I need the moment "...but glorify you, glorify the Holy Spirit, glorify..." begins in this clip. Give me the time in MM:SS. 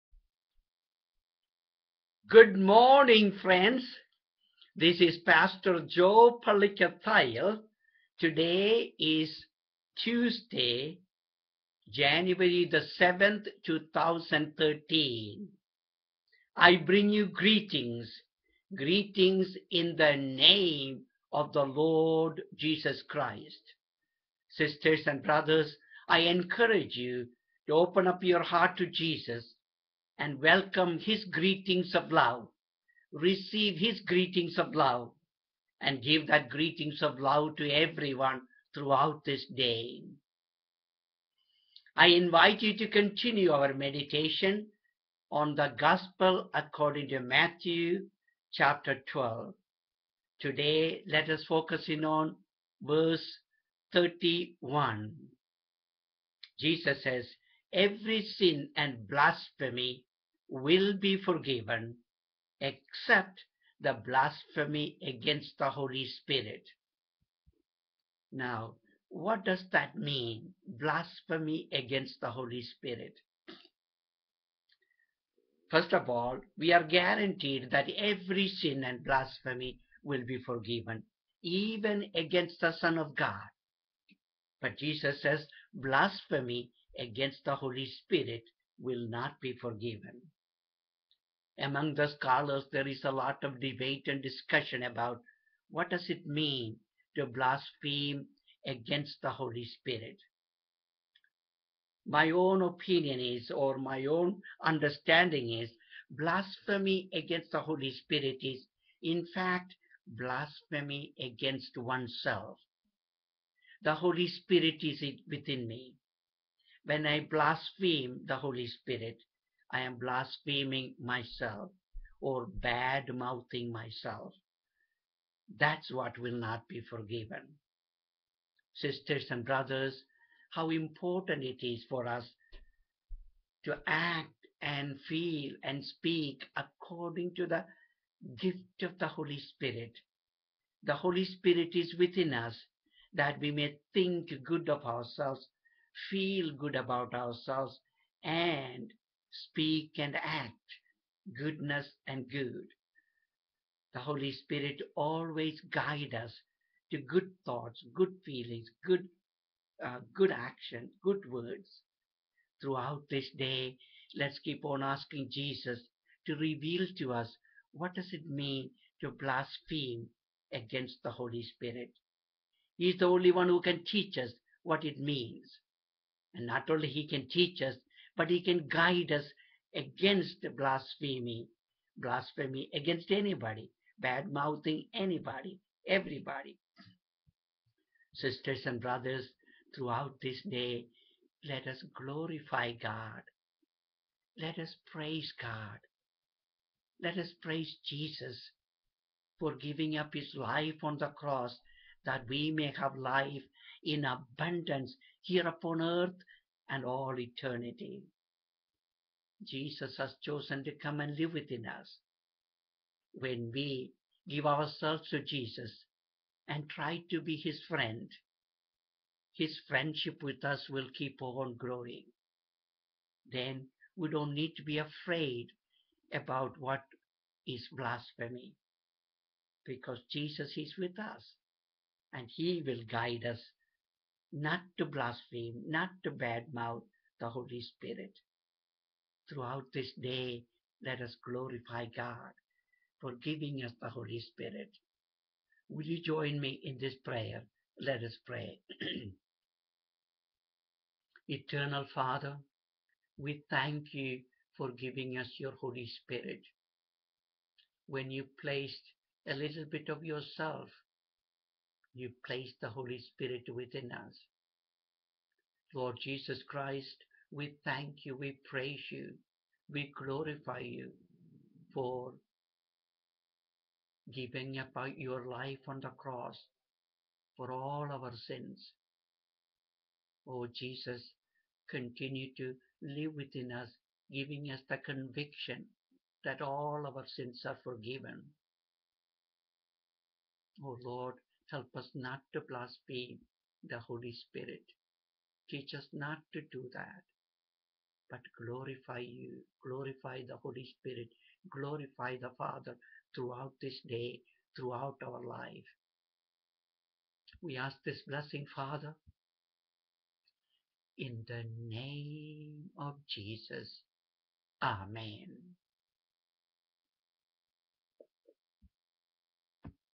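04:58.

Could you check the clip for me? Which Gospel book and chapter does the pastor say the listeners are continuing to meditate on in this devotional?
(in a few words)
Matthew chapter 12.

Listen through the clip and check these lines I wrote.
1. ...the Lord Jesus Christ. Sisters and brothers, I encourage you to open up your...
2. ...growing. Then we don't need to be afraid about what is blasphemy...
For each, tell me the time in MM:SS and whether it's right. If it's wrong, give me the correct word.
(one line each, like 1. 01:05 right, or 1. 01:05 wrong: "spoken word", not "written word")
1. 00:21 right
2. 03:41 right.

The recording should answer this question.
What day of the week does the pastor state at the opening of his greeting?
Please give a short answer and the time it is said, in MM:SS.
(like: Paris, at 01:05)
Tuesday, at 00:10.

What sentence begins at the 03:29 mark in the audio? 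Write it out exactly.
Jesus has chosen to come and live within us.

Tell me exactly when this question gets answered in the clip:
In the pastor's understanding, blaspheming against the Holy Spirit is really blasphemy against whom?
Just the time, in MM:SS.
01:51.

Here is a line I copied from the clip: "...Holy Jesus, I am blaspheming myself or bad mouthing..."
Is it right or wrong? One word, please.
wrong.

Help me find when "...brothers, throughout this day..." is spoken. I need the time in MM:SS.
03:08.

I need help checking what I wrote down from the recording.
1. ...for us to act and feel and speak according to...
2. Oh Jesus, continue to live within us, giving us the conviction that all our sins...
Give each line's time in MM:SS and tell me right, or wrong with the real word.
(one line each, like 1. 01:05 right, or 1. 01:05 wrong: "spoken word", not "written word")
1. 02:11 right
2. 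04:40 right.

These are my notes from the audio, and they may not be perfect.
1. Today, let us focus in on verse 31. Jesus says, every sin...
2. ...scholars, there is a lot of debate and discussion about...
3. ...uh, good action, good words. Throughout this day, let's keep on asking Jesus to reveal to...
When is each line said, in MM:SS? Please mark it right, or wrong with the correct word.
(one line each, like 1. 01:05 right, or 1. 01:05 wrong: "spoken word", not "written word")
1. 00:50 right
2. 01:32 right
3. 02:39 right.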